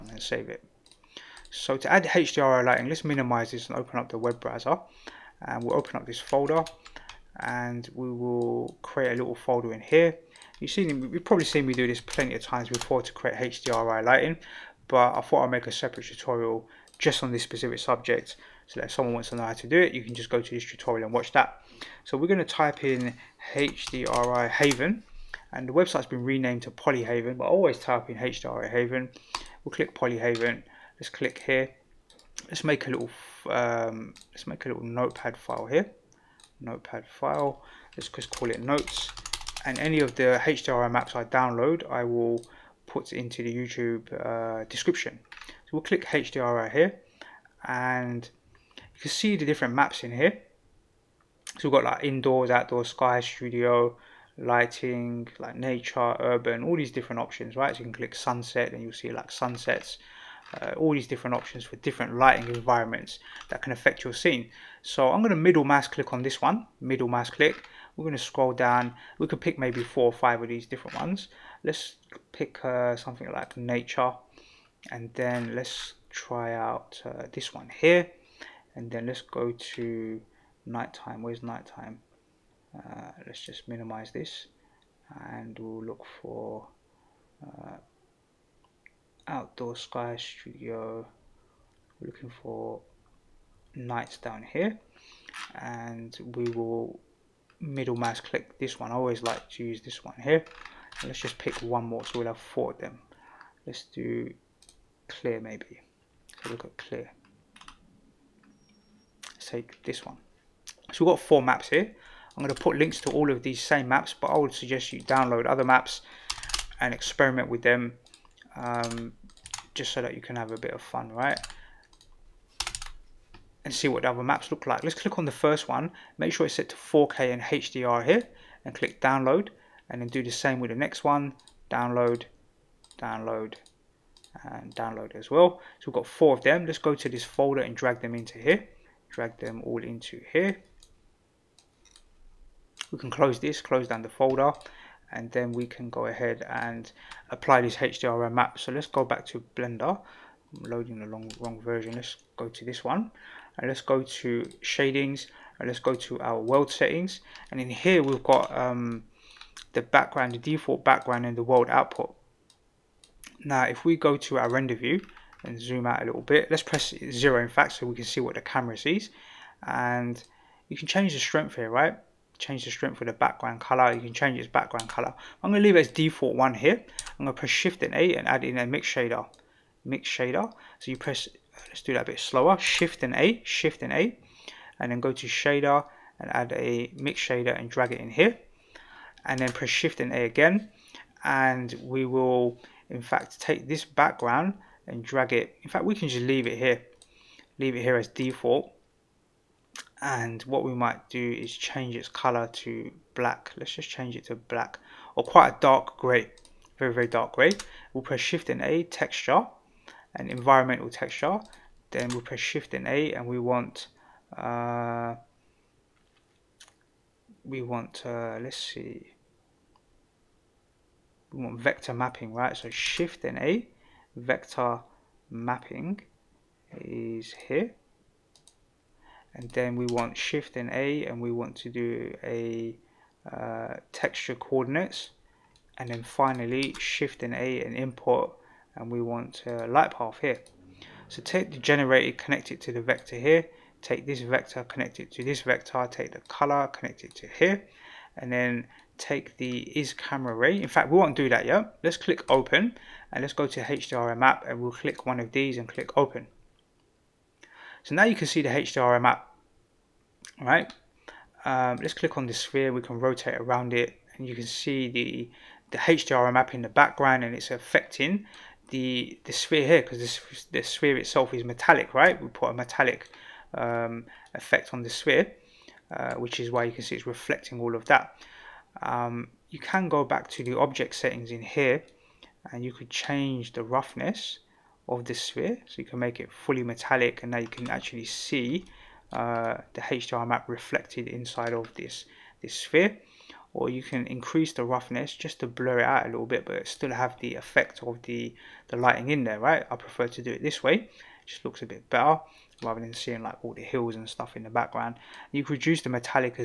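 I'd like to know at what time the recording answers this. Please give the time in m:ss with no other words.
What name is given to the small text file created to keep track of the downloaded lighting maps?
0:38.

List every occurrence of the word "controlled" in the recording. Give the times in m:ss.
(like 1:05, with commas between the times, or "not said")
not said.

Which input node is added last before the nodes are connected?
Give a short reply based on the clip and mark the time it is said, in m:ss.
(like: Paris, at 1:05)
light path, at 3:59.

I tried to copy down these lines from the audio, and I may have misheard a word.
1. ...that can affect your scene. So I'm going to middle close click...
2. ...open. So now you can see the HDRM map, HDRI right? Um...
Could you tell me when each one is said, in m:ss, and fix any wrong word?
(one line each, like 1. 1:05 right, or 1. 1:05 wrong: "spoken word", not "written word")
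1. 1:03 wrong: "mouse", not "close"
2. 4:15 wrong: "All", not "HDRI".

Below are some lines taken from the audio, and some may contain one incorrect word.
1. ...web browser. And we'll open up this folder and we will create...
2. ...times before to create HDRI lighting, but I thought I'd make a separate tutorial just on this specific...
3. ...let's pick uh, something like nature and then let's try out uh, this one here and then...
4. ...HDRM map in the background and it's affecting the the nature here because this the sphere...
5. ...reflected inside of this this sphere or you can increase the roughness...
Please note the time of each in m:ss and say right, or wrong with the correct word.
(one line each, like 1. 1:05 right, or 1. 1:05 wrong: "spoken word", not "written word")
1. 0:04 right
2. 0:12 right
3. 1:11 right
4. 4:25 wrong: "sphere", not "nature"
5. 4:50 right.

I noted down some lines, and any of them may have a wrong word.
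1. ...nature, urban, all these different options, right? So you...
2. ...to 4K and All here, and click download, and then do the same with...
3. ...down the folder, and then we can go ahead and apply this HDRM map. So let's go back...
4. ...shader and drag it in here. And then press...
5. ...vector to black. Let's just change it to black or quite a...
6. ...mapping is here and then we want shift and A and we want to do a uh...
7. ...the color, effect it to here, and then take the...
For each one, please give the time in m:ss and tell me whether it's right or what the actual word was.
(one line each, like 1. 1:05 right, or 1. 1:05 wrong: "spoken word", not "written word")
1. 0:55 right
2. 2:06 wrong: "HDR", not "All"
3. 2:23 right
4. 3:07 right
5. 3:22 wrong: "color", not "vector"
6. 3:45 right
7. 4:06 wrong: "connect", not "effect".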